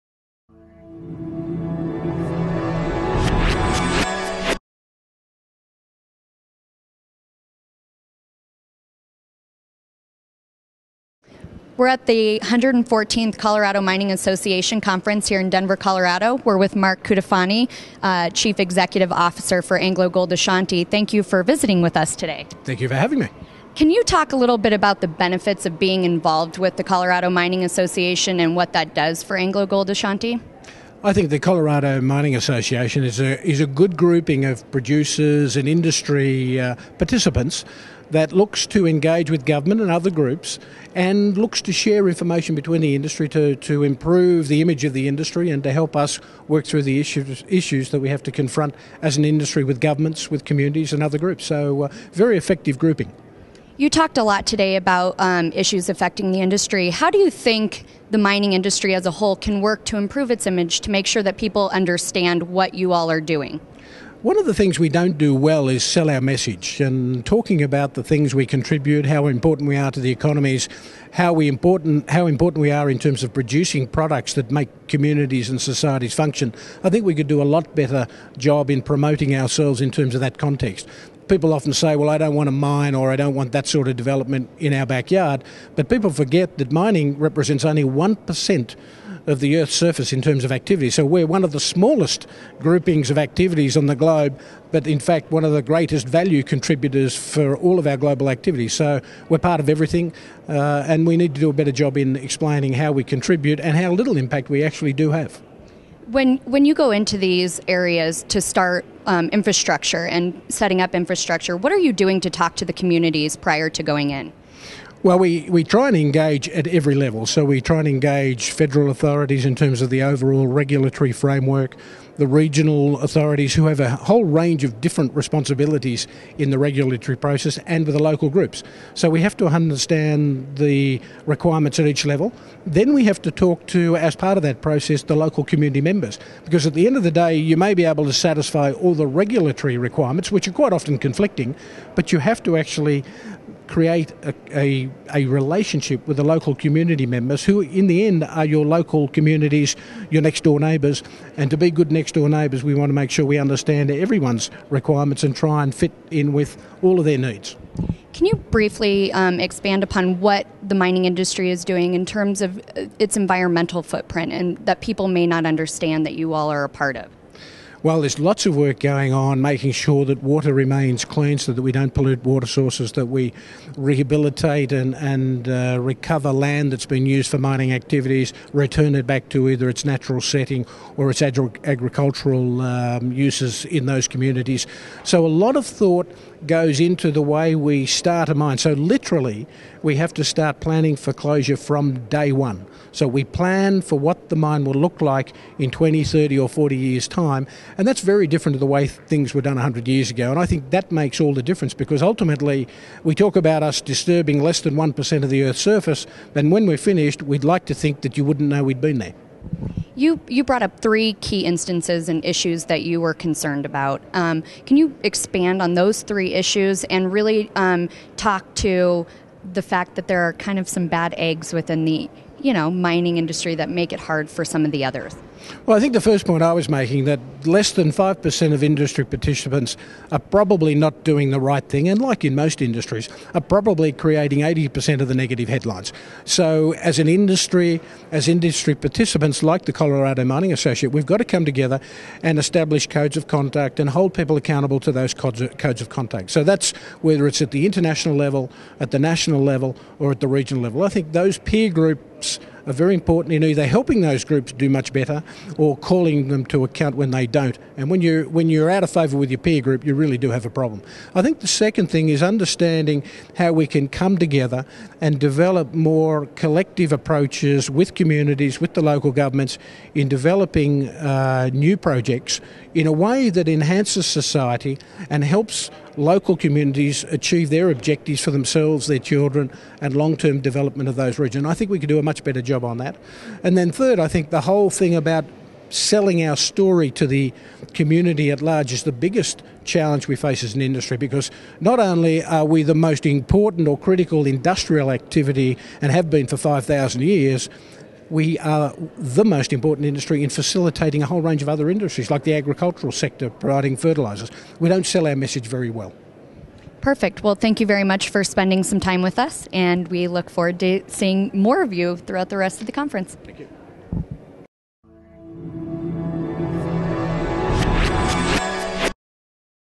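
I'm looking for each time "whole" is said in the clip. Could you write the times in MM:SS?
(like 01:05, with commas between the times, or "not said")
00:59, 02:03, 04:44, 05:01.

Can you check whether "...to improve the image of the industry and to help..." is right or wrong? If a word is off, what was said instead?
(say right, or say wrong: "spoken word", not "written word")
right.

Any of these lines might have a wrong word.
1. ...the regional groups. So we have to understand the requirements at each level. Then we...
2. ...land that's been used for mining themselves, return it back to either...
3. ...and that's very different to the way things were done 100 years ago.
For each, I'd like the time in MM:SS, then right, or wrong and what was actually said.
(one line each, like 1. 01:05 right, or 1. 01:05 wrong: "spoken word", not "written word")
1. 02:07 wrong: "local", not "regional"
2. 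02:56 wrong: "activities", not "themselves"
3. 03:17 right.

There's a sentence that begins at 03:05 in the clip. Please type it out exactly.
So, a lot of thought goes into the way we start a mine.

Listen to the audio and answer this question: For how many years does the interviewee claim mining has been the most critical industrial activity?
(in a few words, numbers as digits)
5,000 years.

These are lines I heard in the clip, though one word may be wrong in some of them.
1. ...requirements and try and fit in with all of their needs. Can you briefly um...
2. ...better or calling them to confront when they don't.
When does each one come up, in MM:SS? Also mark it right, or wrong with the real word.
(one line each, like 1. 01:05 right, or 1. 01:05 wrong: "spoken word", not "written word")
1. 02:34 right
2. 04:14 wrong: "account", not "confront".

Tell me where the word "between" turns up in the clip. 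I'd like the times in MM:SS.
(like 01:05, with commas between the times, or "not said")
00:42.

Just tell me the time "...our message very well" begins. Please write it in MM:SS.
05:05.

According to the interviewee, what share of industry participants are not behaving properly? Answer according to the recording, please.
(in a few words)
less than 5%.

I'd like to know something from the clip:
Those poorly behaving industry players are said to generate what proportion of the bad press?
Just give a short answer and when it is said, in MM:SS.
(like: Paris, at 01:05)
80%, at 03:54.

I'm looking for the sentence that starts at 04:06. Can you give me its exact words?
So, that's whether it's at the international level, at the national level, or at the regional level.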